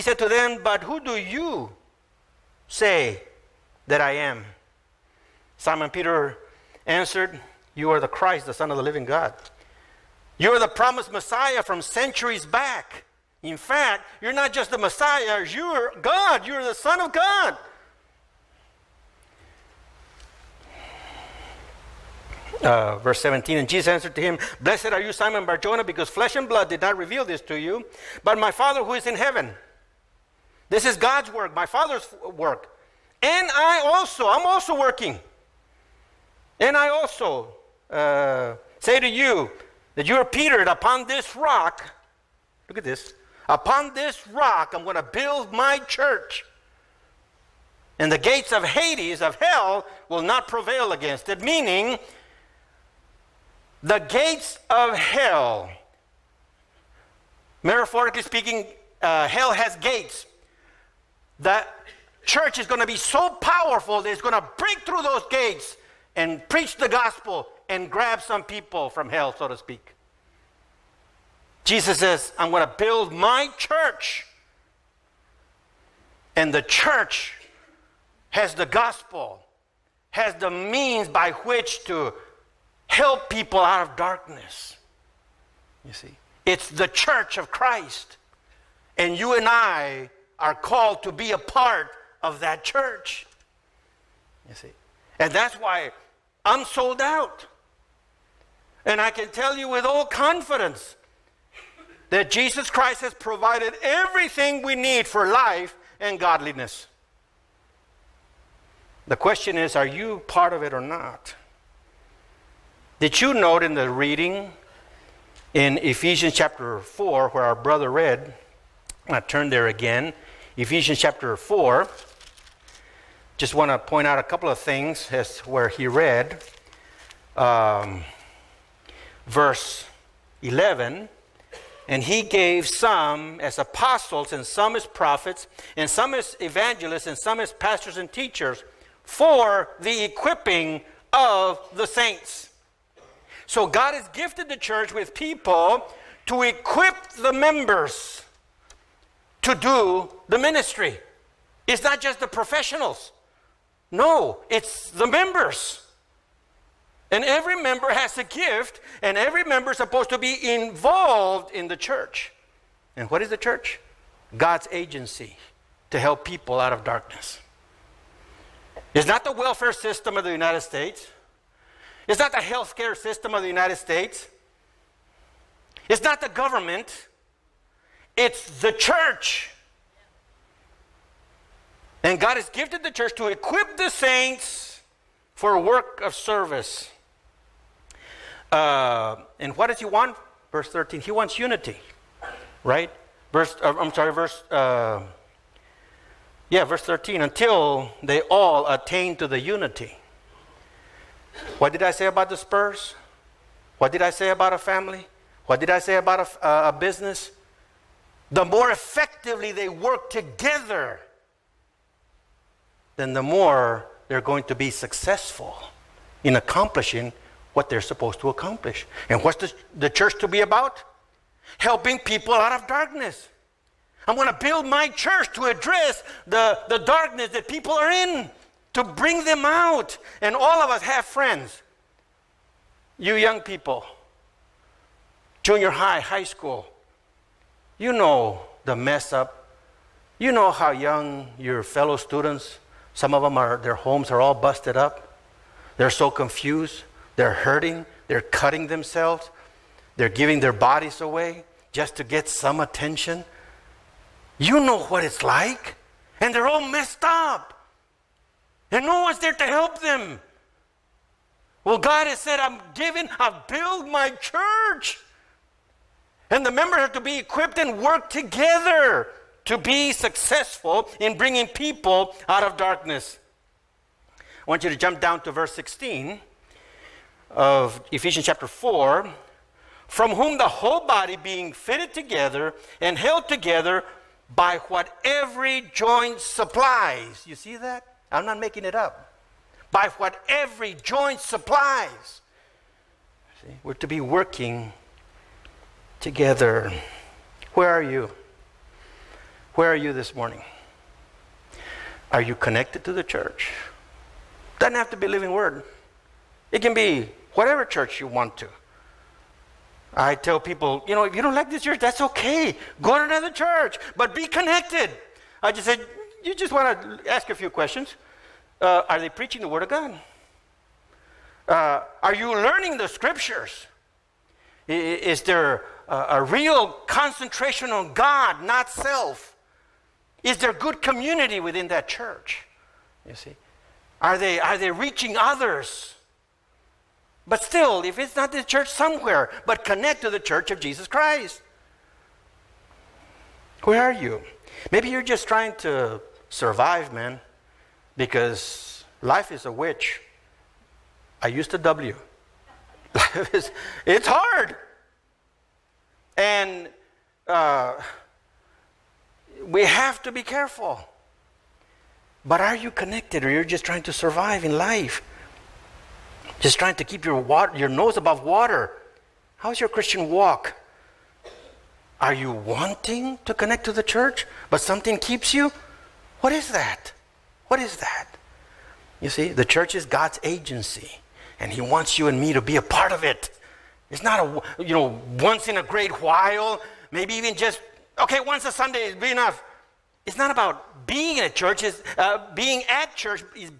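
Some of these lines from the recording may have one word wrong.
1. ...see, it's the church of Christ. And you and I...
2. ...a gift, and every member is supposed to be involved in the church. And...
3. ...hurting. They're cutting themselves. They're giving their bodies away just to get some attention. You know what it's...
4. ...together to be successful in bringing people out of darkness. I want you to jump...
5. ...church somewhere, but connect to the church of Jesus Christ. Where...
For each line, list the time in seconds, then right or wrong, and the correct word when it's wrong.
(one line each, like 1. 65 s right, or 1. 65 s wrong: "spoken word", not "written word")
1. 85 s right
2. 158 s right
3. 247 s right
4. 268 s right
5. 338 s right.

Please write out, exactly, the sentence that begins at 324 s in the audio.
Is there a, a real concentration on God, not self?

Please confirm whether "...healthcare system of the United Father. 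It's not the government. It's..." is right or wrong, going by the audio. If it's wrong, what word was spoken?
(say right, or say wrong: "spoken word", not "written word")
wrong: "States", not "Father".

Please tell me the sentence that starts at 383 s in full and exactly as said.
It's not a, you know, once in a great while, maybe even just, okay, once a Sunday is be enough.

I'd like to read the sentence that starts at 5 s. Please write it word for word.
Simon Peter answered, You are the Christ, the Son of the living God.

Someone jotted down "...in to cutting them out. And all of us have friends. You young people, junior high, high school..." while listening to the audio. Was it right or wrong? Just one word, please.
wrong.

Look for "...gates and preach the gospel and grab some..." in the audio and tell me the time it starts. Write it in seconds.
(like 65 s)
65 s.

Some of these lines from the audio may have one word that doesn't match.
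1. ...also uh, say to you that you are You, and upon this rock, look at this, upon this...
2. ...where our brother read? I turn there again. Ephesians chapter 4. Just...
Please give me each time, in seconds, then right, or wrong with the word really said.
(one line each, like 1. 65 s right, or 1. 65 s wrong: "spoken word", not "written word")
1. 36 s wrong: "Peter", not "You"
2. 117 s right.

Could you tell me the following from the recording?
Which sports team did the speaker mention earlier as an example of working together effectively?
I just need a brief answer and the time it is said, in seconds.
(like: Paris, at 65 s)
the Spurs, at 202 s.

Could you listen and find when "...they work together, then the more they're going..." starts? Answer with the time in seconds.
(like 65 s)
209 s.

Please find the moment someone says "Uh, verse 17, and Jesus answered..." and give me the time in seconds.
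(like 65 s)
22 s.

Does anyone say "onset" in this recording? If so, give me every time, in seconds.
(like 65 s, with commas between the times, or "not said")
not said.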